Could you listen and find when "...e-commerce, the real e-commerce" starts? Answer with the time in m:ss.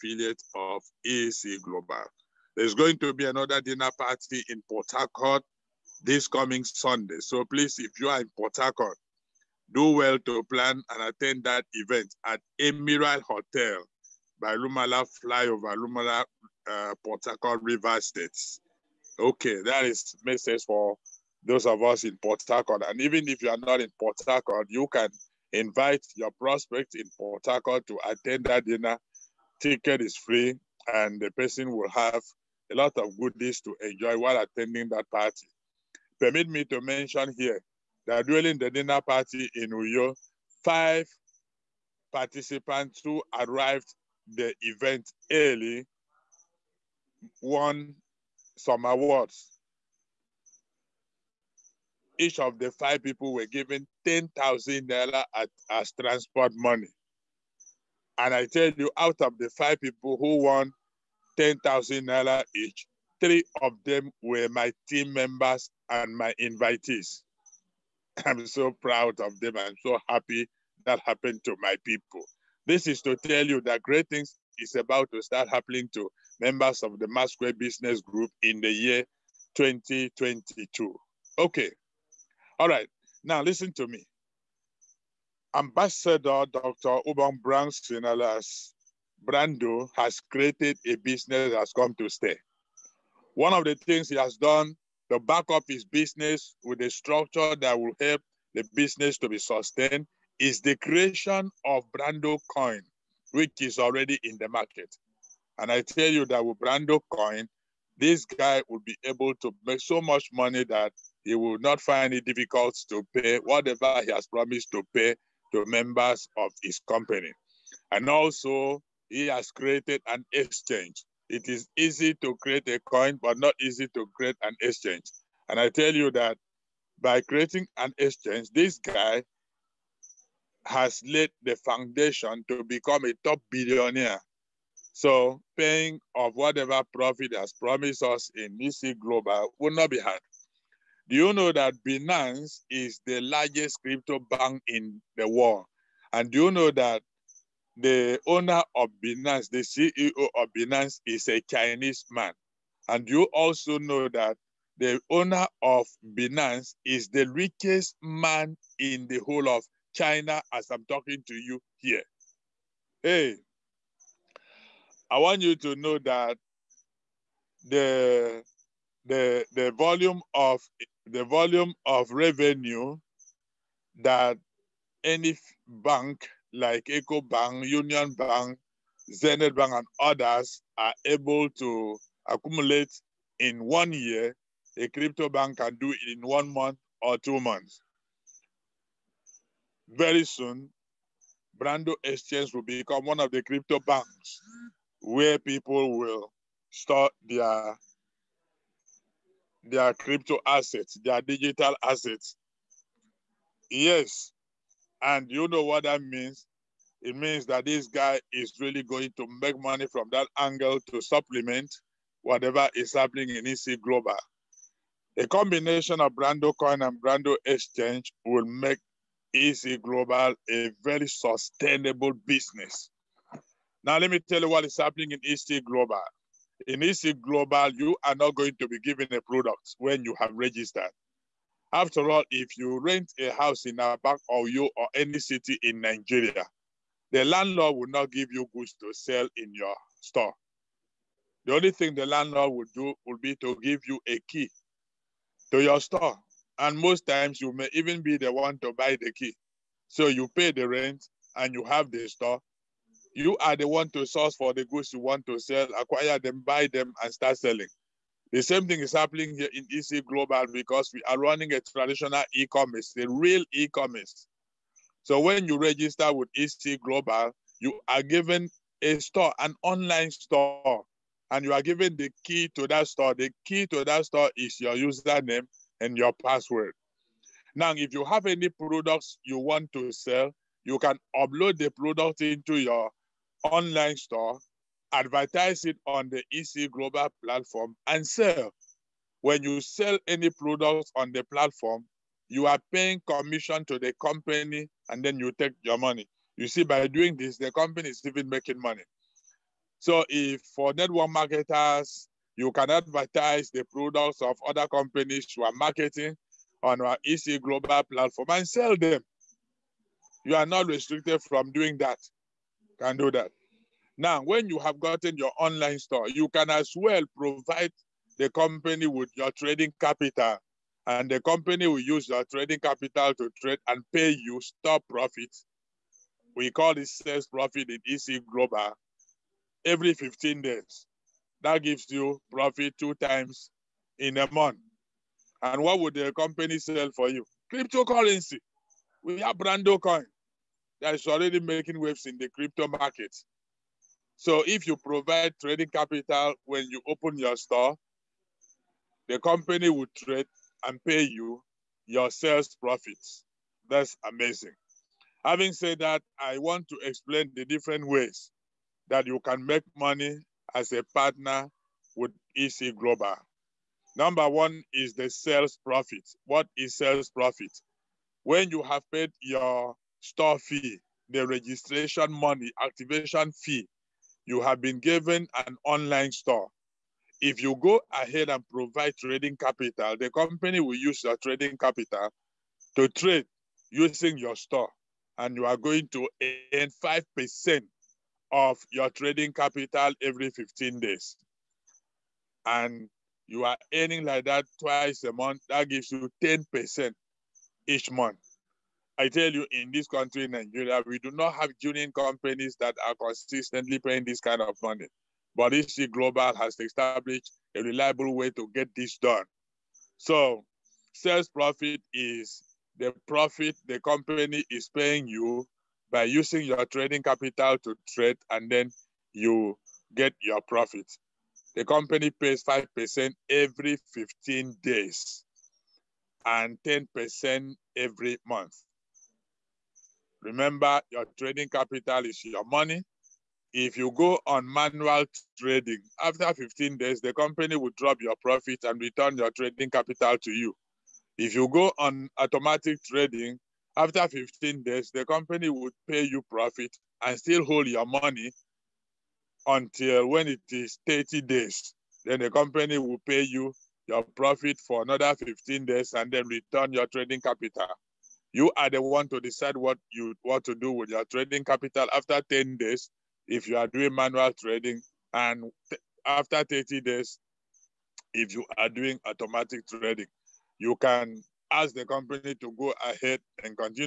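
4:22.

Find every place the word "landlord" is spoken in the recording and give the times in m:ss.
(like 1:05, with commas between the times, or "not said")
3:57, 4:02.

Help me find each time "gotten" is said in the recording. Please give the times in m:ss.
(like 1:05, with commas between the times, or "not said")
5:14.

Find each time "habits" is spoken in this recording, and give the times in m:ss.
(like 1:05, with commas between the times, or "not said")
not said.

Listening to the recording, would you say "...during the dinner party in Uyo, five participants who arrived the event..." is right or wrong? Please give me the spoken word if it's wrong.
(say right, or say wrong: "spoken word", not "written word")
right.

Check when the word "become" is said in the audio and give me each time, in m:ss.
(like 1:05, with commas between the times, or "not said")
2:12, 3:12.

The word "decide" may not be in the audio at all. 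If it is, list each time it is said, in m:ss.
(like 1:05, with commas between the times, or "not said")
7:39.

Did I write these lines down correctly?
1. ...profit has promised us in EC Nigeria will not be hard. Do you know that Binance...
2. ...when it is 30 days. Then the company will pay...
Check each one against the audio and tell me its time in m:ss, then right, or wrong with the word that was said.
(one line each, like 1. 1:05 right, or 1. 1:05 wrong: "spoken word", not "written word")
1. 2:16 wrong: "Global", not "Nigeria"
2. 7:30 right.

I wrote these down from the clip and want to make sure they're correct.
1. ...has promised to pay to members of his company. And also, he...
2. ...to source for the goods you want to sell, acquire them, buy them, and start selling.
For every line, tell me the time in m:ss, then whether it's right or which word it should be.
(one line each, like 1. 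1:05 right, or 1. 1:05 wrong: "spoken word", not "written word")
1. 1:54 right
2. 4:13 right.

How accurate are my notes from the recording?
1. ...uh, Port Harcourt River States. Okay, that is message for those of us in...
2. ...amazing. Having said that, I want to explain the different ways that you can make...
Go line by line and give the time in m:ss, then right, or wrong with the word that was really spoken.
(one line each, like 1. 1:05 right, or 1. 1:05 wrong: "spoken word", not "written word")
1. 0:16 right
2. 5:54 right.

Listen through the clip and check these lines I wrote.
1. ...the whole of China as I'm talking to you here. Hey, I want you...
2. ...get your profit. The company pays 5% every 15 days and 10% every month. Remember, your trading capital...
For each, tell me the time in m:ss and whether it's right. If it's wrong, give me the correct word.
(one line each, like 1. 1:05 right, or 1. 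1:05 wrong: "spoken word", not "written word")
1. 2:39 right
2. 6:59 right.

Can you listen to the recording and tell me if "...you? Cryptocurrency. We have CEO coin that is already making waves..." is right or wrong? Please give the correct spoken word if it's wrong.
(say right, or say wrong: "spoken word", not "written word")
wrong: "Brando", not "CEO".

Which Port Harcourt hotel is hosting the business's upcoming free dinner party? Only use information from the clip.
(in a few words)
Emiral Hotel.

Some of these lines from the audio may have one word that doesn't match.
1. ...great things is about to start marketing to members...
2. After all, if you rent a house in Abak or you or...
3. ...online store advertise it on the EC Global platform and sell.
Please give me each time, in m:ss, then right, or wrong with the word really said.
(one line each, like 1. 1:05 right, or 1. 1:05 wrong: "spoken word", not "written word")
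1. 1:13 wrong: "happening", not "marketing"
2. 3:51 right
3. 4:43 right.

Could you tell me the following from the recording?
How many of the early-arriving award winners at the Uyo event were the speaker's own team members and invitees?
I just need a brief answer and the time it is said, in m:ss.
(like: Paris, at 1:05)
3, at 1:03.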